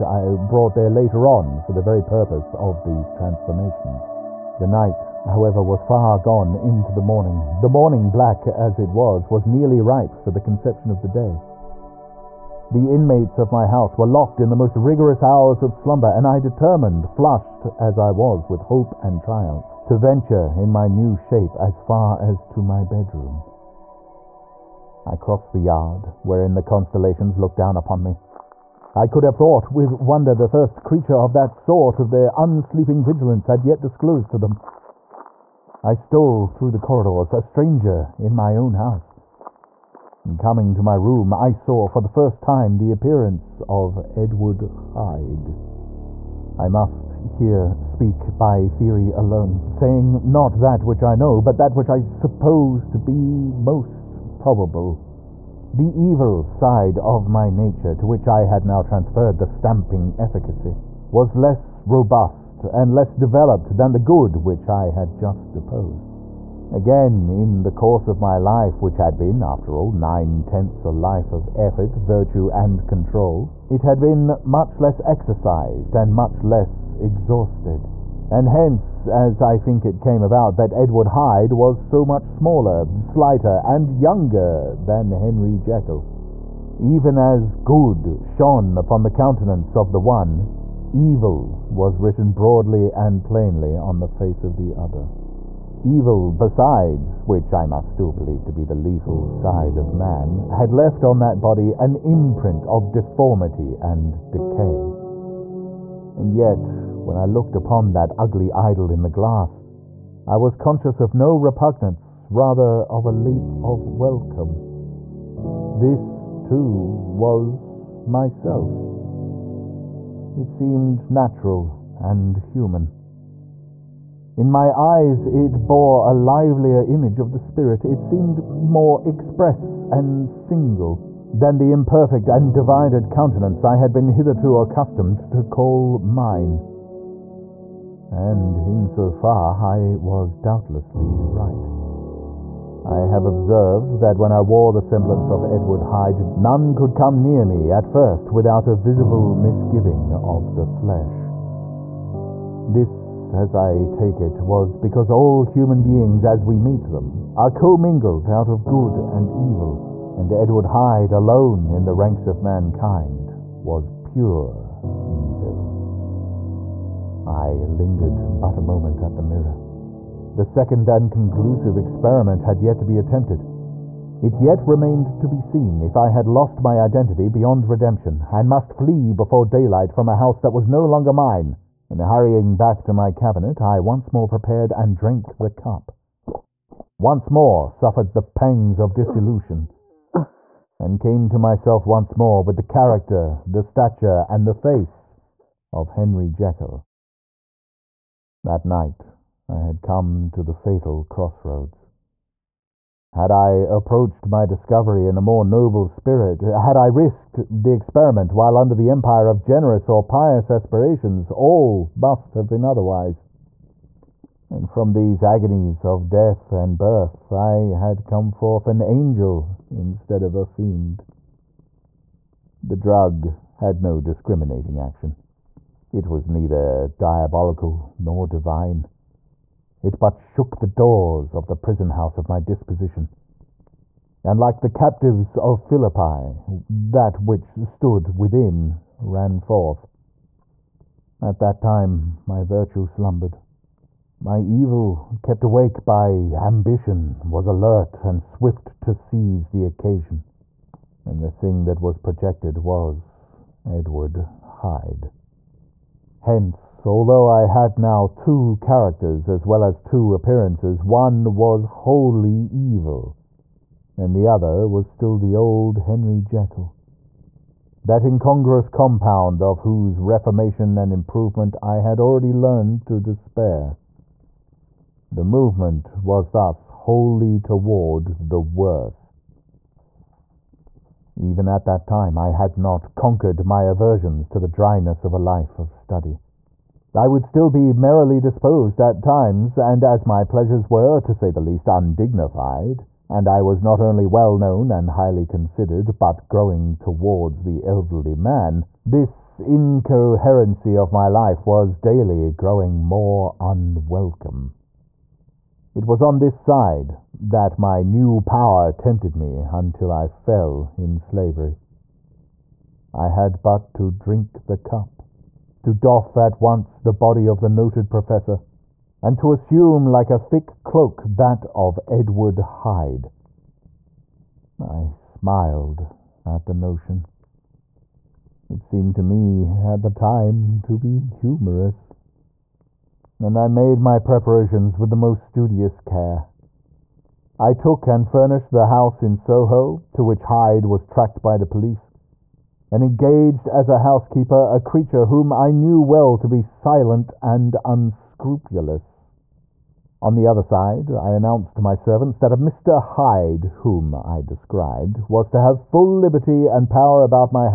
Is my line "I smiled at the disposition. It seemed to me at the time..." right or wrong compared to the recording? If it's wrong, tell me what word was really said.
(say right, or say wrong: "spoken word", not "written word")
wrong: "notion", not "disposition".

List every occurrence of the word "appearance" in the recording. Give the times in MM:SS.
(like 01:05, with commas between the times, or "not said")
00:42, 04:20.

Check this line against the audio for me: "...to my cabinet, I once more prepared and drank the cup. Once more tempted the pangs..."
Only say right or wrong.
wrong.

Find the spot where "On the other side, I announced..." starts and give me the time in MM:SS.
05:49.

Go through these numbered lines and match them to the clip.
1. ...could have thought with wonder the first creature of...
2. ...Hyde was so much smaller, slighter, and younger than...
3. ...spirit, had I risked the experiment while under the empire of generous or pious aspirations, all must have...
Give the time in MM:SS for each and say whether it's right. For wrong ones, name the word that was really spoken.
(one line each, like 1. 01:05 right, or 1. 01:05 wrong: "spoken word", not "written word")
1. 00:29 right
2. 01:21 right
3. 03:25 right.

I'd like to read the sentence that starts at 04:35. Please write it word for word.
The movement was thus wholly toward the worse.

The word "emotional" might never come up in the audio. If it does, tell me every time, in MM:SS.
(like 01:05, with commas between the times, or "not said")
not said.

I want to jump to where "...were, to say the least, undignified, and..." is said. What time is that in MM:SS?
04:50.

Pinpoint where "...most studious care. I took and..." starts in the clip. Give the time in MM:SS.
05:34.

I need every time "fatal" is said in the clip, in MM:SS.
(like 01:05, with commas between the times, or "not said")
03:20.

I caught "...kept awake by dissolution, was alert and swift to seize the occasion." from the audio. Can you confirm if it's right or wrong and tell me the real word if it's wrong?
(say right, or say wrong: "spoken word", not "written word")
wrong: "ambition", not "dissolution".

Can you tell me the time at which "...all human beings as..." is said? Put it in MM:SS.
02:35.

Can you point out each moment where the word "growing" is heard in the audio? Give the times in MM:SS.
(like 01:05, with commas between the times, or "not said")
04:56, 05:02.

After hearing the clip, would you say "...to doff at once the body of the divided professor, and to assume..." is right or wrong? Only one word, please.
wrong.